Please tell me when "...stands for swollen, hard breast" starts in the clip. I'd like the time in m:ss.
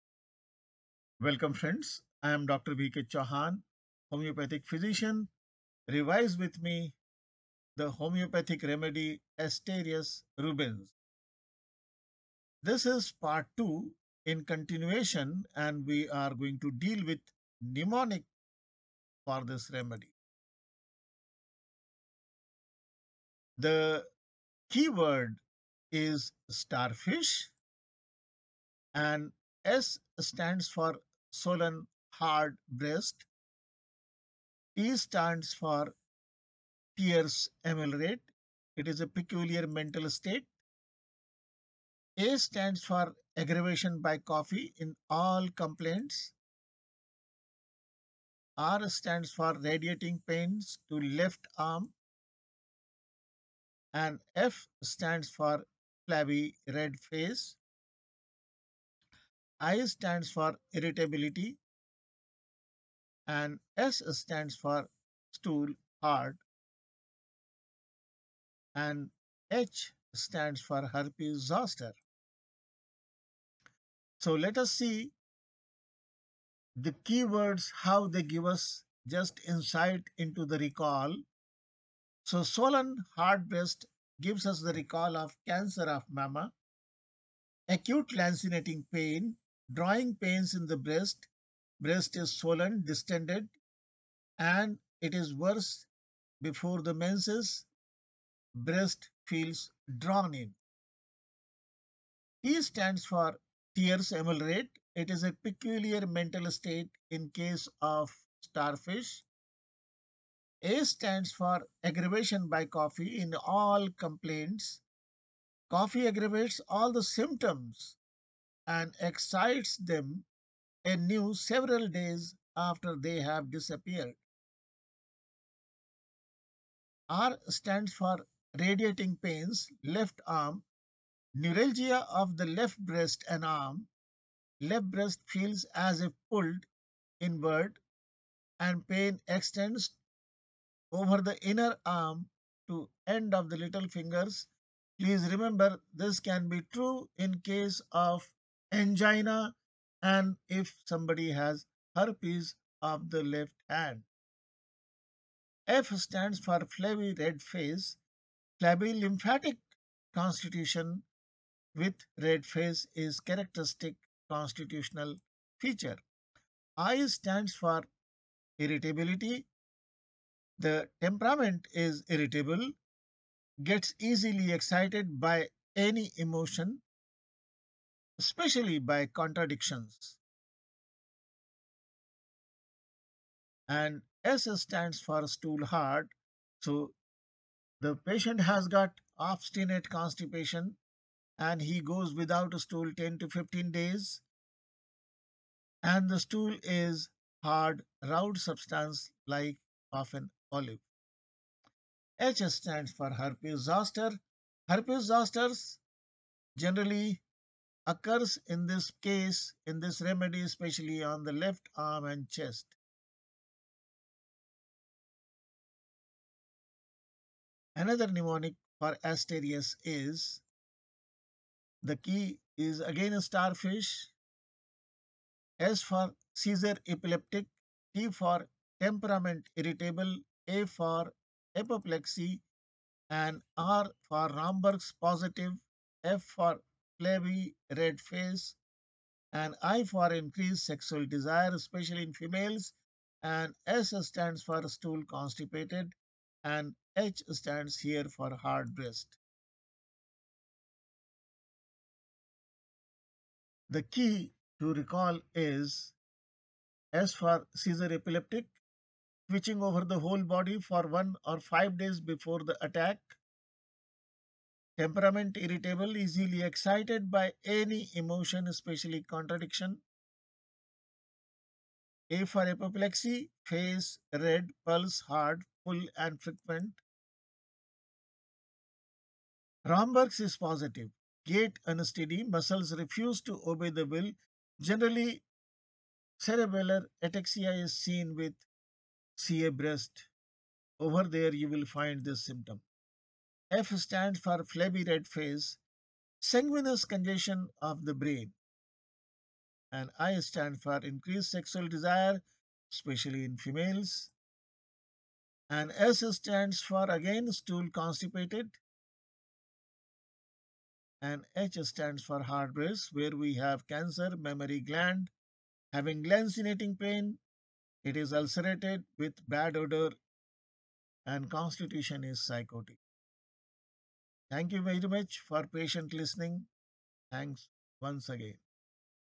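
0:30.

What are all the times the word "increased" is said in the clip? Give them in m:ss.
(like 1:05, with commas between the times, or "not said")
4:00, 5:00.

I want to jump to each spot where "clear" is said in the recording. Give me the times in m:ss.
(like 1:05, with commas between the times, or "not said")
not said.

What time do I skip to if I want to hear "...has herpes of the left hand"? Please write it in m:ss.
2:31.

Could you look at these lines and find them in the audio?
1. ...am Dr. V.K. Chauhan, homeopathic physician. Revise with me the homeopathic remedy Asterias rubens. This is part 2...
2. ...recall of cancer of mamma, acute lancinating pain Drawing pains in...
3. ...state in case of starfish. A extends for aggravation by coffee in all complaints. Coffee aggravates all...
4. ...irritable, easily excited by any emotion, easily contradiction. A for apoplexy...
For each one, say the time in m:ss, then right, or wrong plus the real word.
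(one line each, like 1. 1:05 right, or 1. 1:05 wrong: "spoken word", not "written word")
1. 0:02 right
2. 1:24 right
3. 1:46 wrong: "stands", not "extends"
4. 4:25 wrong: "especially", not "easily".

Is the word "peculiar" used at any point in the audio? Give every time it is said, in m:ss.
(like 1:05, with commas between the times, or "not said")
0:39, 1:45.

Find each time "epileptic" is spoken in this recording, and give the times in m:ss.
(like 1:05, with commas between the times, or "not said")
3:46, 4:17.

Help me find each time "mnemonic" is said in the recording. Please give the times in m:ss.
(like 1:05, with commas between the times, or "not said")
0:17, 3:38.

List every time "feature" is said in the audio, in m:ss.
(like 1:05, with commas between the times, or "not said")
2:45.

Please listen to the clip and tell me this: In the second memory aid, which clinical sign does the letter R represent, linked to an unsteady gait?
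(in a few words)
Romberg's positive.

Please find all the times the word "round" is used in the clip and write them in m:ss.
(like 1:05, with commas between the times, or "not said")
3:18.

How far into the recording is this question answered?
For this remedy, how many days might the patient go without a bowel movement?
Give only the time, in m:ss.
3:13.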